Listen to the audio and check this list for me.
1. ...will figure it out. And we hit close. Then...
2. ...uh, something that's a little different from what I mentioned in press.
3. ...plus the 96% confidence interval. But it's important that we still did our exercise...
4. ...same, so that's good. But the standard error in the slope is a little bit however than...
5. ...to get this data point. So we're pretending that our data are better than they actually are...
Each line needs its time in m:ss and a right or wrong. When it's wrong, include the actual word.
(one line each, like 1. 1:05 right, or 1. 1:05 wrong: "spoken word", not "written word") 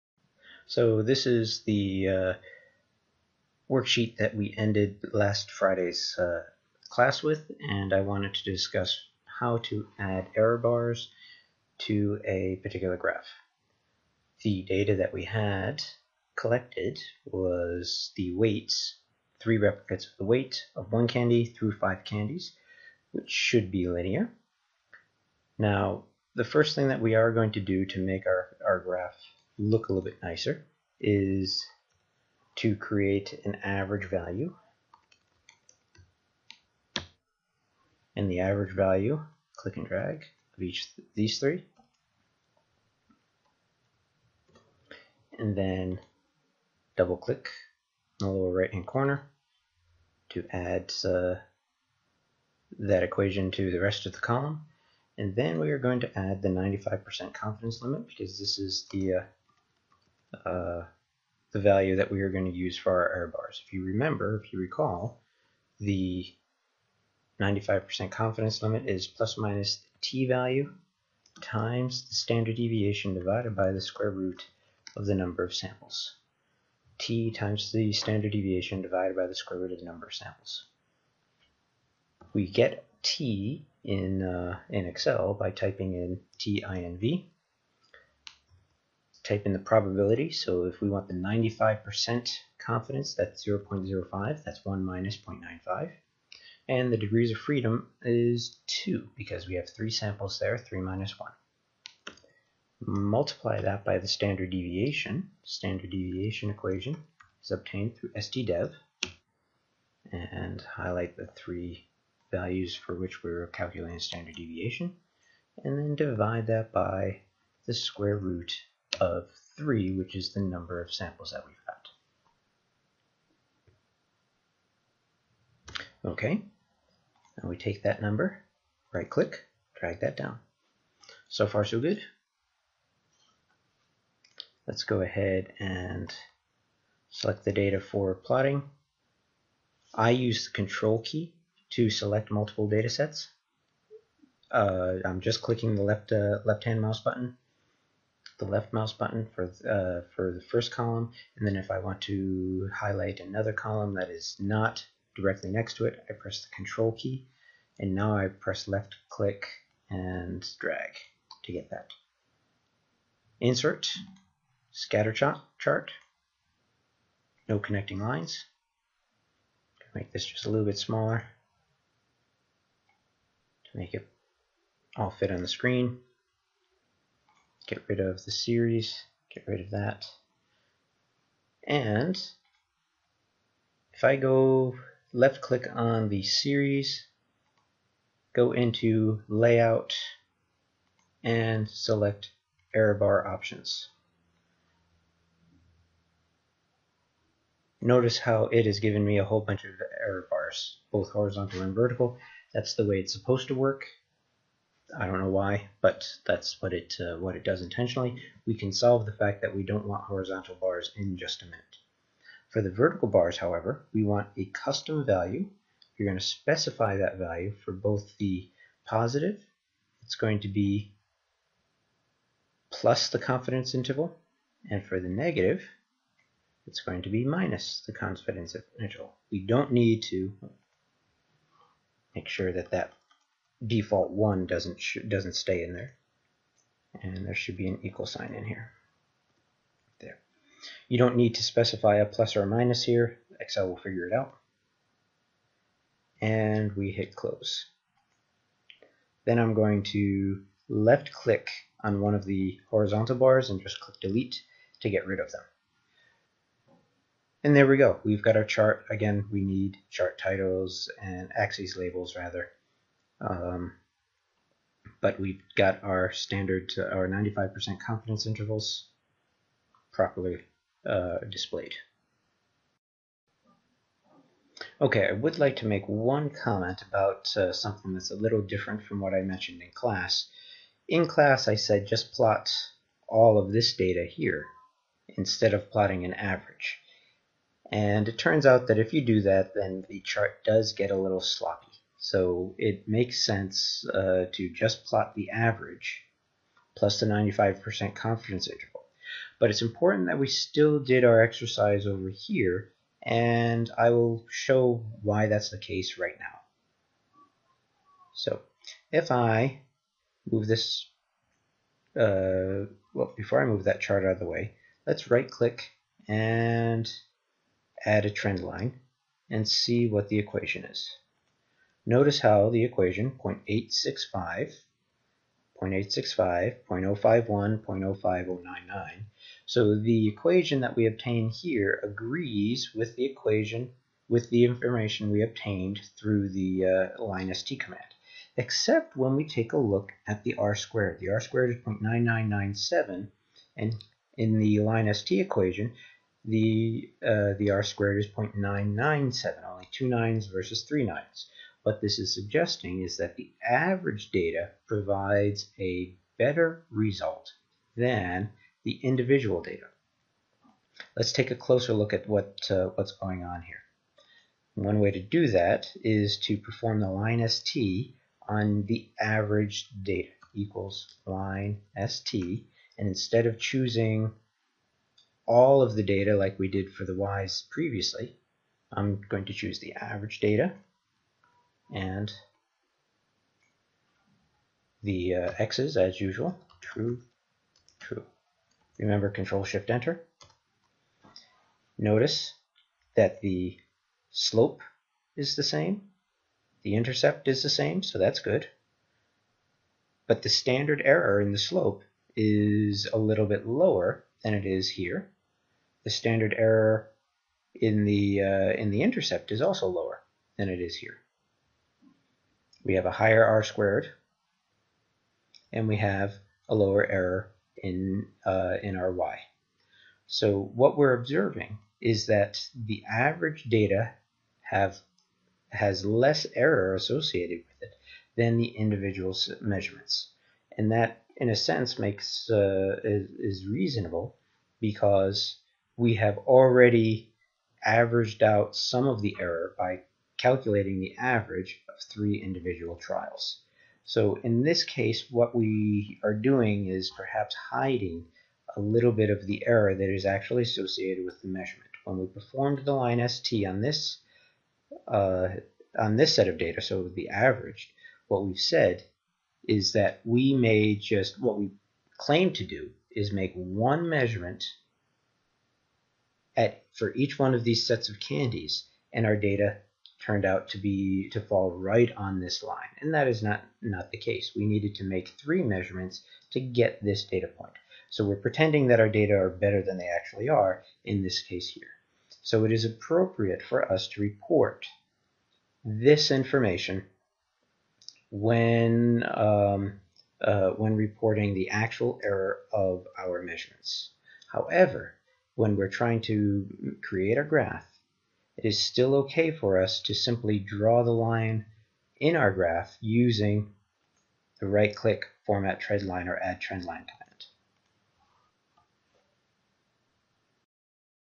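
1. 4:03 right
2. 4:37 wrong: "class", not "press"
3. 4:56 wrong: "95", not "96"
4. 6:37 wrong: "lower", not "however"
5. 7:56 right.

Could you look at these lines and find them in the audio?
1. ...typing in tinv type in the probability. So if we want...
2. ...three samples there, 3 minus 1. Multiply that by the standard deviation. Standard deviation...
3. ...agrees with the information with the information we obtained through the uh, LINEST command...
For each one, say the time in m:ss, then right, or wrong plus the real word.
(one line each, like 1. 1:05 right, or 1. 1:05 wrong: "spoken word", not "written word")
1. 1:25 right
2. 1:39 right
3. 5:31 wrong: "equation", not "information".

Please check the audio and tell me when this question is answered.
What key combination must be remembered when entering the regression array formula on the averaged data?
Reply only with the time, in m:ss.
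6:29.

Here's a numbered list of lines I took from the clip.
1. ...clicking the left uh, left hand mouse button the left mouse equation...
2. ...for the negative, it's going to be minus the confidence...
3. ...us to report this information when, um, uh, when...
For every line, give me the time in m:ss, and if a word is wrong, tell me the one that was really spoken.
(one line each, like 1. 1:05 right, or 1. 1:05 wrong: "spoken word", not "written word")
1. 2:25 wrong: "button", not "equation"
2. 3:44 right
3. 8:03 right.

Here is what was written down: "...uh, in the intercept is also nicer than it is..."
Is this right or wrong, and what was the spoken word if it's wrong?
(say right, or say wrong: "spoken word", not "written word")
wrong: "lower", not "nicer".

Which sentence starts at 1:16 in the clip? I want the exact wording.
t times the standard deviation divided by the square root of the number of samples.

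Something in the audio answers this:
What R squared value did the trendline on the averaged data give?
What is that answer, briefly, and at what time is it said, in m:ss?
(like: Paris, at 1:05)
0.9997, at 5:41.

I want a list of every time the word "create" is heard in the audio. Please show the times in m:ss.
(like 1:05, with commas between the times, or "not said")
0:32, 8:16.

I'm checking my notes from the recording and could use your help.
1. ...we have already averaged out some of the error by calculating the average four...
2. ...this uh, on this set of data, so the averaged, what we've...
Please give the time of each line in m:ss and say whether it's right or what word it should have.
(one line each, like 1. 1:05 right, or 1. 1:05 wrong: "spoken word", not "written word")
1. 7:15 wrong: "three", not "four"
2. 7:33 right.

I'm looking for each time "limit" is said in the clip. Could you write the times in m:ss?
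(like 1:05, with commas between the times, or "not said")
0:57, 1:08.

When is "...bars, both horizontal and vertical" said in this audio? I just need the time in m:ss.
3:20.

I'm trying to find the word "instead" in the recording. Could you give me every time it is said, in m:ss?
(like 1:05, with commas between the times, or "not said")
4:45, 6:12.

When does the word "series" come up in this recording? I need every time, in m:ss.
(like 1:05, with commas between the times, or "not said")
2:58, 3:06.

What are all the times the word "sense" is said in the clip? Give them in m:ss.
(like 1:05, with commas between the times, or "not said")
4:53, 7:11.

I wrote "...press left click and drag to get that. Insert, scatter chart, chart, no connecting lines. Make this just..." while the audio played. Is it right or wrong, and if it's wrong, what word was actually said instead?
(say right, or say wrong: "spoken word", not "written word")
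right.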